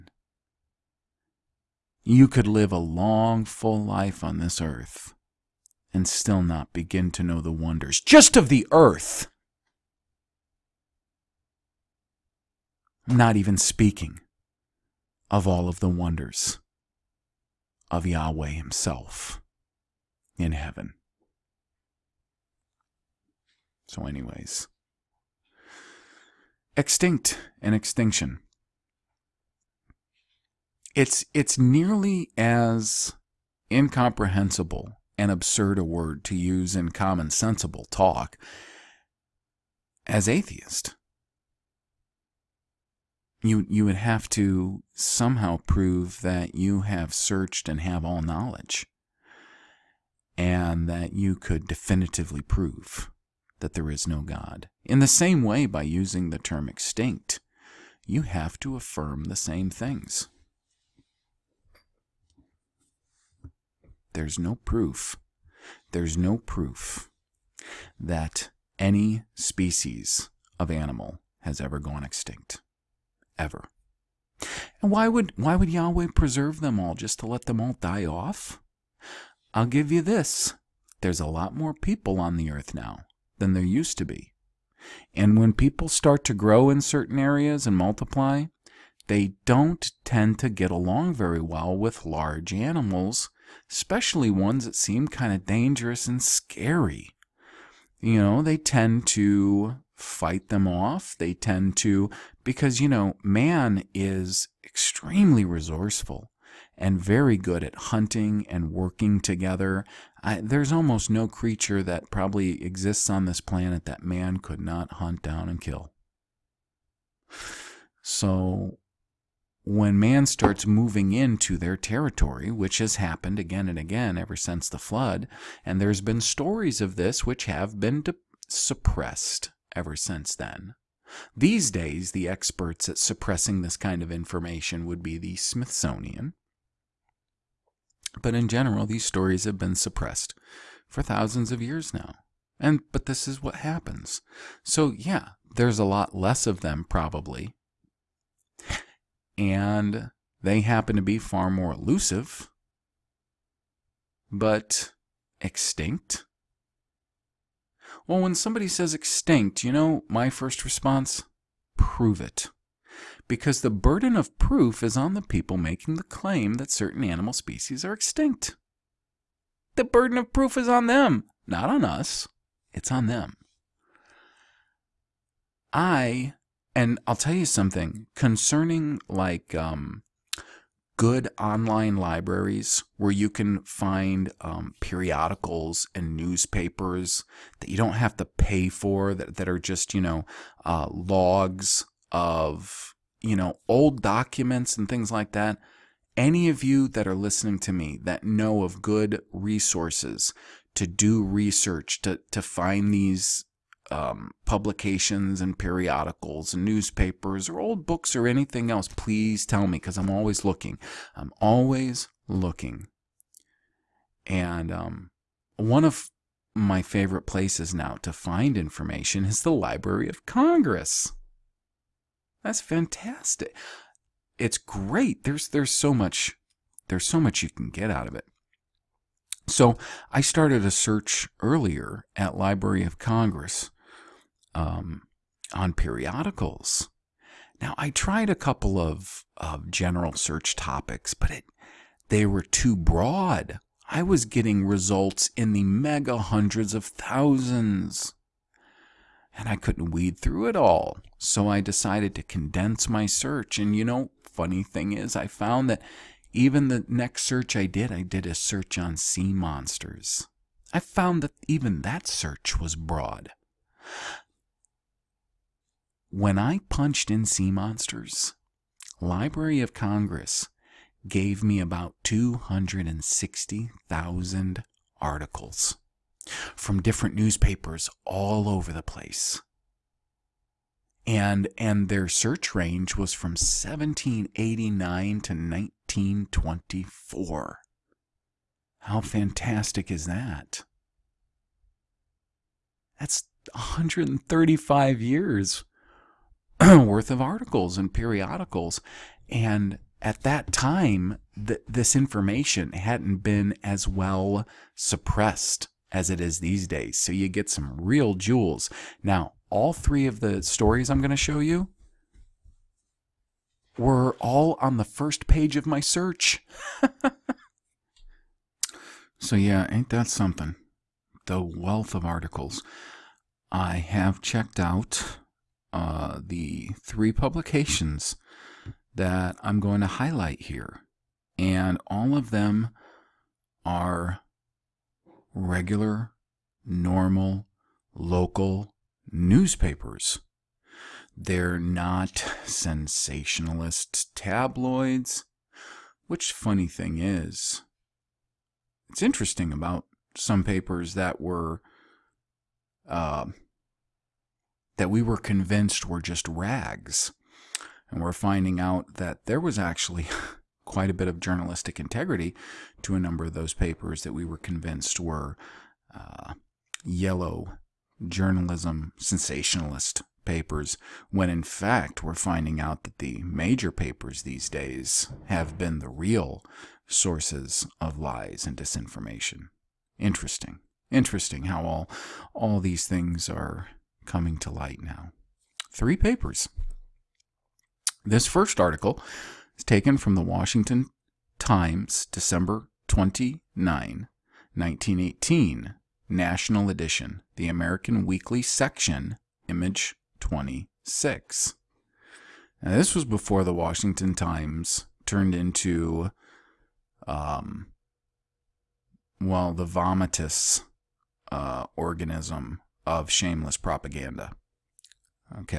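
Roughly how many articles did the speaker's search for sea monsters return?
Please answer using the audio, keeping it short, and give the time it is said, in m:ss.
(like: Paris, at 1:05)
260,000, at 4:32.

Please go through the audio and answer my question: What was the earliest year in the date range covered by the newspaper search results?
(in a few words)
1789.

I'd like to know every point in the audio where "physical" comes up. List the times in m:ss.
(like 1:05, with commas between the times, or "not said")
not said.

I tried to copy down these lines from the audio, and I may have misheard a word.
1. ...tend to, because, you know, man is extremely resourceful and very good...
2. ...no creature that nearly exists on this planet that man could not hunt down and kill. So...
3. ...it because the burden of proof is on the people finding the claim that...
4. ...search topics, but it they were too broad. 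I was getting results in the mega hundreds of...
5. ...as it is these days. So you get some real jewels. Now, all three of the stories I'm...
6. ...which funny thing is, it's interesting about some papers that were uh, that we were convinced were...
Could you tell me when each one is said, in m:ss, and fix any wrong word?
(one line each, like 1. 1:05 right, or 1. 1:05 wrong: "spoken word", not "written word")
1. 1:41 right
2. 1:51 wrong: "probably", not "nearly"
3. 2:42 wrong: "making", not "finding"
4. 4:00 right
5. 5:05 right
6. 5:46 right.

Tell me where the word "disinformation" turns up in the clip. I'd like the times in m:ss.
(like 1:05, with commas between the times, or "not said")
6:18.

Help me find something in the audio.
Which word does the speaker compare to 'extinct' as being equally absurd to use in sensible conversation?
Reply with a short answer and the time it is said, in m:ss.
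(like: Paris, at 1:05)
atheist, at 0:40.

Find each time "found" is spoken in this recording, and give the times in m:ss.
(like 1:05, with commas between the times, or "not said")
4:15, 4:20.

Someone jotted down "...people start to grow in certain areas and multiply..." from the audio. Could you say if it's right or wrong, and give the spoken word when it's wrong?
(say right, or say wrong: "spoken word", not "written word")
right.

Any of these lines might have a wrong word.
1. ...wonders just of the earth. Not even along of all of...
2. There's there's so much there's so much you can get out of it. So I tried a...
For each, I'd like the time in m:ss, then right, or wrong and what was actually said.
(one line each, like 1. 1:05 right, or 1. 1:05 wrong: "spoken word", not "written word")
1. 0:07 wrong: "speaking", not "along"
2. 3:45 wrong: "started", not "tried".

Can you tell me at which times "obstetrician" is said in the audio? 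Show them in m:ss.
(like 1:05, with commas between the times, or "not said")
not said.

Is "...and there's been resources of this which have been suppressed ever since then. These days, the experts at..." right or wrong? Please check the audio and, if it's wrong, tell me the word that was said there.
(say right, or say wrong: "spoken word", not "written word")
wrong: "stories", not "resources".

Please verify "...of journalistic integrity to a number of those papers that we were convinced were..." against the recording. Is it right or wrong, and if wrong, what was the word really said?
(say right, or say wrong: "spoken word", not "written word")
right.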